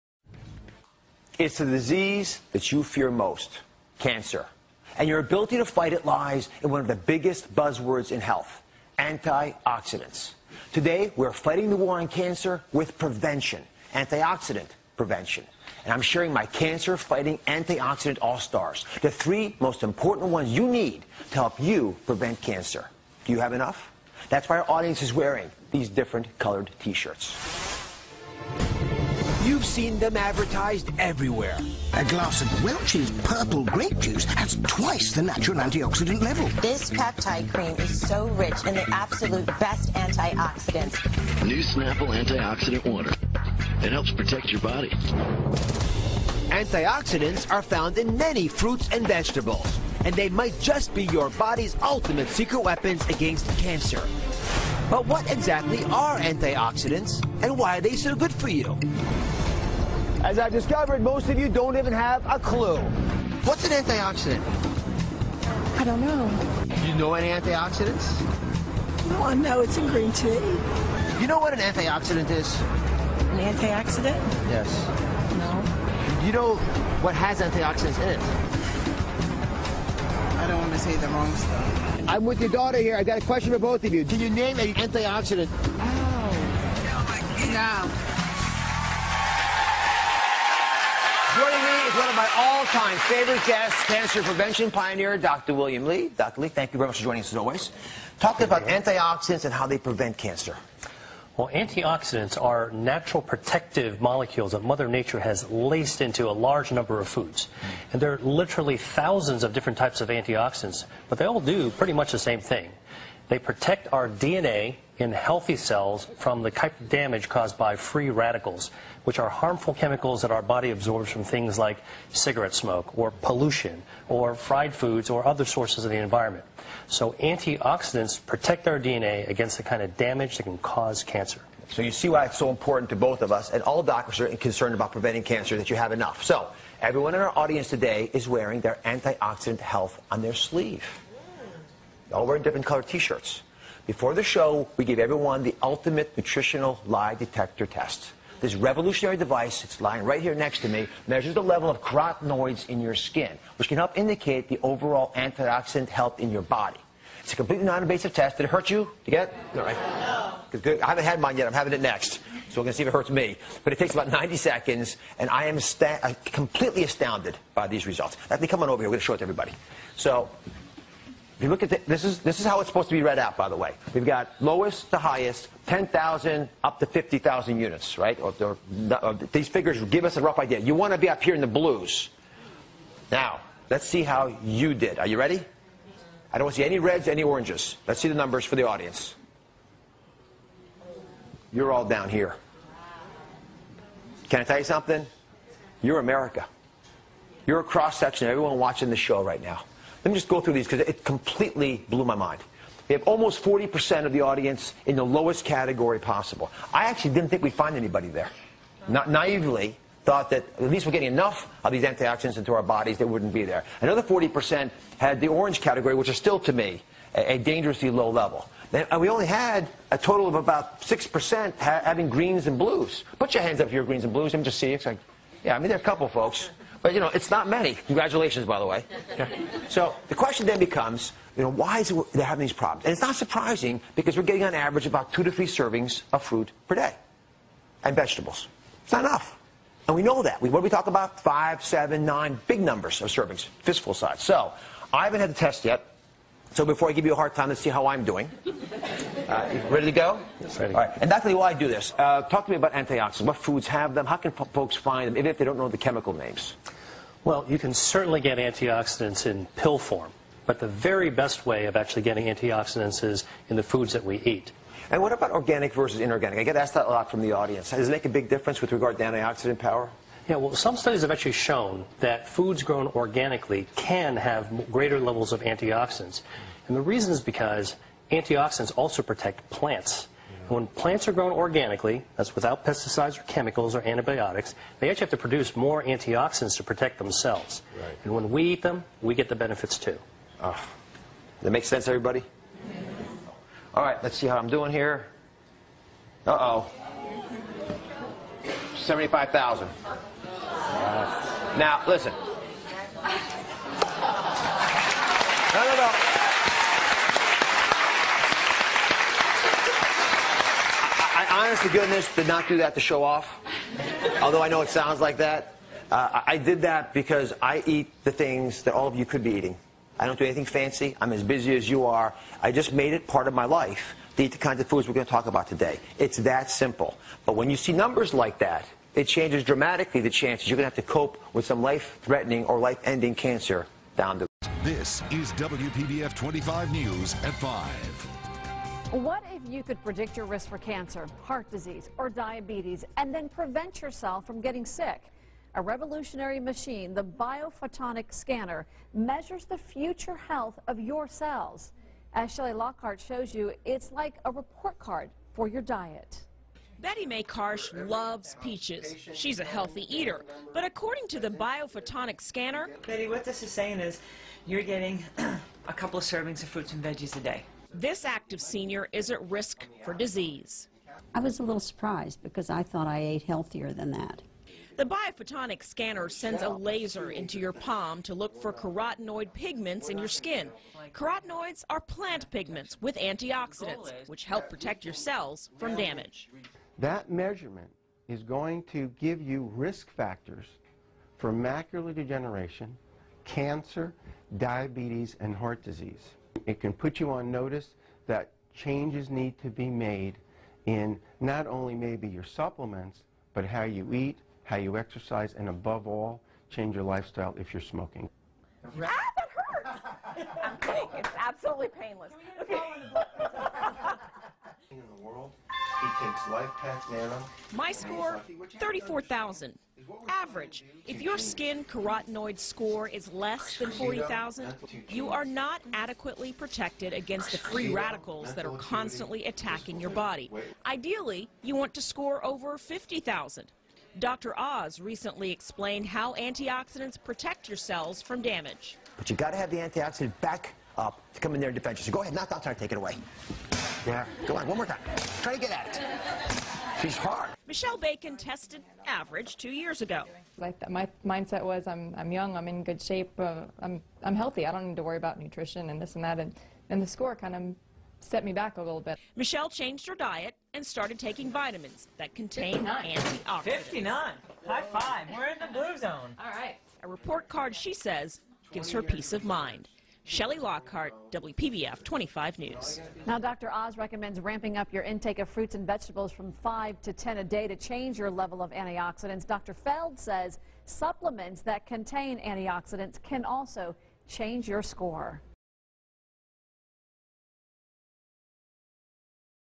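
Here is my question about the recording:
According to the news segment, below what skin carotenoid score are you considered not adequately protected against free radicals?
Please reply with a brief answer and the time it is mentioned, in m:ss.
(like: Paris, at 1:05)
40,000, at 7:03.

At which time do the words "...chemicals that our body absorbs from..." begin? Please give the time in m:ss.
1:59.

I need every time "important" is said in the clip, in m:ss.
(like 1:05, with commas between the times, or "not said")
0:19, 2:12.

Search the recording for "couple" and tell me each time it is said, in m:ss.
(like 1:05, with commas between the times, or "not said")
3:45, 6:05.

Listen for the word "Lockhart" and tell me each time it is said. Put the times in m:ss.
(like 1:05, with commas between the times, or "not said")
5:52, 7:50.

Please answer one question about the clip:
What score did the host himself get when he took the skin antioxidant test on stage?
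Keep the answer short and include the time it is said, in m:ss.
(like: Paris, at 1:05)
75,000, at 4:58.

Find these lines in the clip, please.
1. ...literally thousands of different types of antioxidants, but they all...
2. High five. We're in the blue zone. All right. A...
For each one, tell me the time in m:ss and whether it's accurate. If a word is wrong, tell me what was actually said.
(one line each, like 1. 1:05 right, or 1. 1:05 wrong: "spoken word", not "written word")
1. 1:48 right
2. 7:44 right.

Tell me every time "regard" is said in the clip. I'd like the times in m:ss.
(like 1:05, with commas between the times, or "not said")
4:28.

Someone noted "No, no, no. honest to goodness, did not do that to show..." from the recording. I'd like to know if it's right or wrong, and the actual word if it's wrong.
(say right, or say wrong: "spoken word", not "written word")
right.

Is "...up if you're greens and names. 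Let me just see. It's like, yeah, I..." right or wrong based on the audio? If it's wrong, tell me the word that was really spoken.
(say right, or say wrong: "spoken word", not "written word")
wrong: "blues", not "names".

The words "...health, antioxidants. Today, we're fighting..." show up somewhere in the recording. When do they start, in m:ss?
0:08.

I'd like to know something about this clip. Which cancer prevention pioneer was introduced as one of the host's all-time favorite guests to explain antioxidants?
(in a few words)
Dr. William Li.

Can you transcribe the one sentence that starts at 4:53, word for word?
All right, let's see how I'm doing here.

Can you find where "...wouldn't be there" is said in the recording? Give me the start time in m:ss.
3:33.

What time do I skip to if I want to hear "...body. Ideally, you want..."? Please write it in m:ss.
7:09.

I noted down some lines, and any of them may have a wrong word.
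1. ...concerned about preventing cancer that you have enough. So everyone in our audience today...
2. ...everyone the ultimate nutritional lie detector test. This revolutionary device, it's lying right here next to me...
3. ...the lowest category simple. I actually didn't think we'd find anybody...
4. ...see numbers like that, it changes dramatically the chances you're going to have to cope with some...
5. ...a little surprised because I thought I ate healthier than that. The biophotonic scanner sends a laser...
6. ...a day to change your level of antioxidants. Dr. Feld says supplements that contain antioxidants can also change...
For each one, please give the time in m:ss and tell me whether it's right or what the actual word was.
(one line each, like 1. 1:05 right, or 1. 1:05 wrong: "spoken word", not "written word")
1. 2:14 right
2. 2:24 right
3. 3:24 wrong: "possible", not "simple"
4. 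5:27 right
5. 6:11 right
6. 7:57 right.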